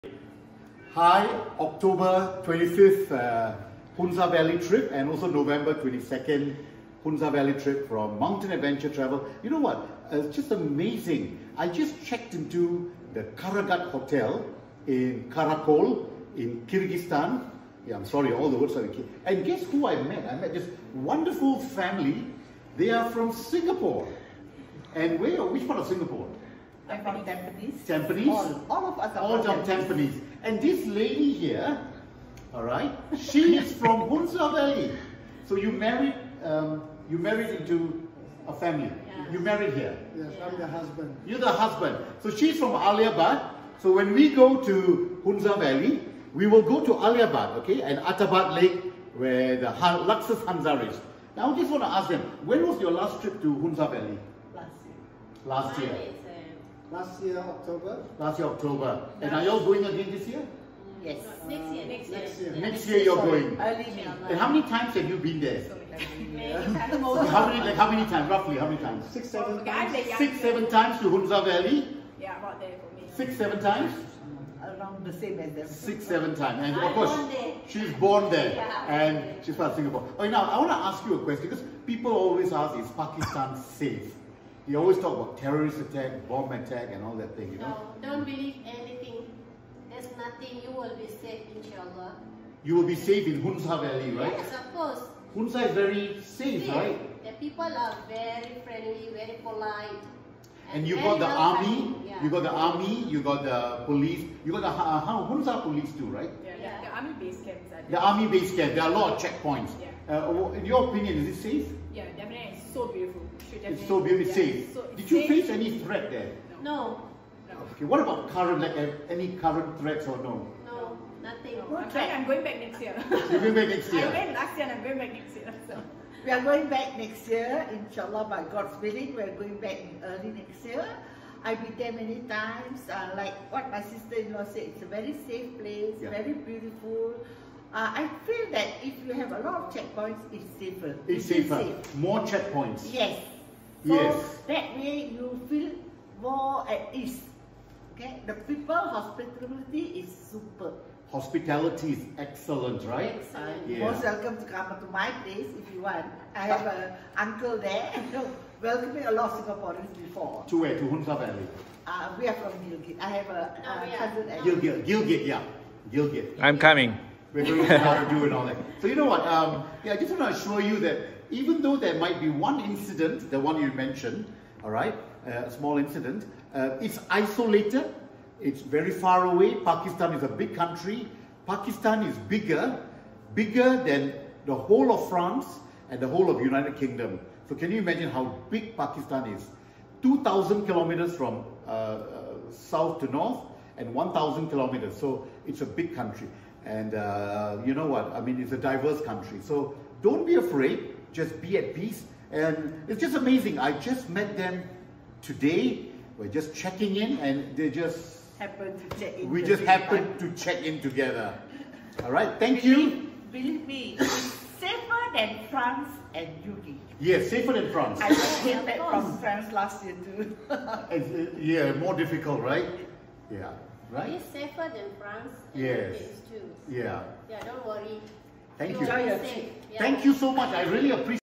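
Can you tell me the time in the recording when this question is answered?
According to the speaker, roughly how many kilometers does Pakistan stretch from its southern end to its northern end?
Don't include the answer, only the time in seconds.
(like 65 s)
190 s.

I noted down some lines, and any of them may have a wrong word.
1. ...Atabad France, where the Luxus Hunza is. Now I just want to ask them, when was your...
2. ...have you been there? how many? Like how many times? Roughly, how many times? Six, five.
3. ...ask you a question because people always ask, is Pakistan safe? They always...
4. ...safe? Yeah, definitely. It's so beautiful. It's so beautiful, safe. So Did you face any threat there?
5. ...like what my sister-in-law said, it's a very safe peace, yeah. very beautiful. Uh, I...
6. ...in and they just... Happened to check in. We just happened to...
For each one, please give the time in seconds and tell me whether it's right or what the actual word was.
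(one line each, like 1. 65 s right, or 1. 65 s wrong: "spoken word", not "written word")
1. 47 s wrong: "Lake", not "France"
2. 64 s wrong: "seven", not "five"
3. 80 s right
4. 111 s right
5. 133 s wrong: "place", not "peace"
6. 206 s right.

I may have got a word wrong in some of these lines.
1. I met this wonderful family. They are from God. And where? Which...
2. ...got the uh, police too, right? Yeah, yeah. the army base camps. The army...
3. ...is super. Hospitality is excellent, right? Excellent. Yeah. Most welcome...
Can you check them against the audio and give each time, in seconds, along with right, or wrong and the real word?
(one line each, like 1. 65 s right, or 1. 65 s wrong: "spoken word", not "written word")
1. 20 s wrong: "Singapore", not "God"
2. 104 s right
3. 150 s right.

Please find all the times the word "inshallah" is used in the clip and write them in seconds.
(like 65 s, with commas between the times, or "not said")
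91 s, 127 s.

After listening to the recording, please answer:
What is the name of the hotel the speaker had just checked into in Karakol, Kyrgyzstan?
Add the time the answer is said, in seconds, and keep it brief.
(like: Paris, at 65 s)
Karagat Hotel, at 13 s.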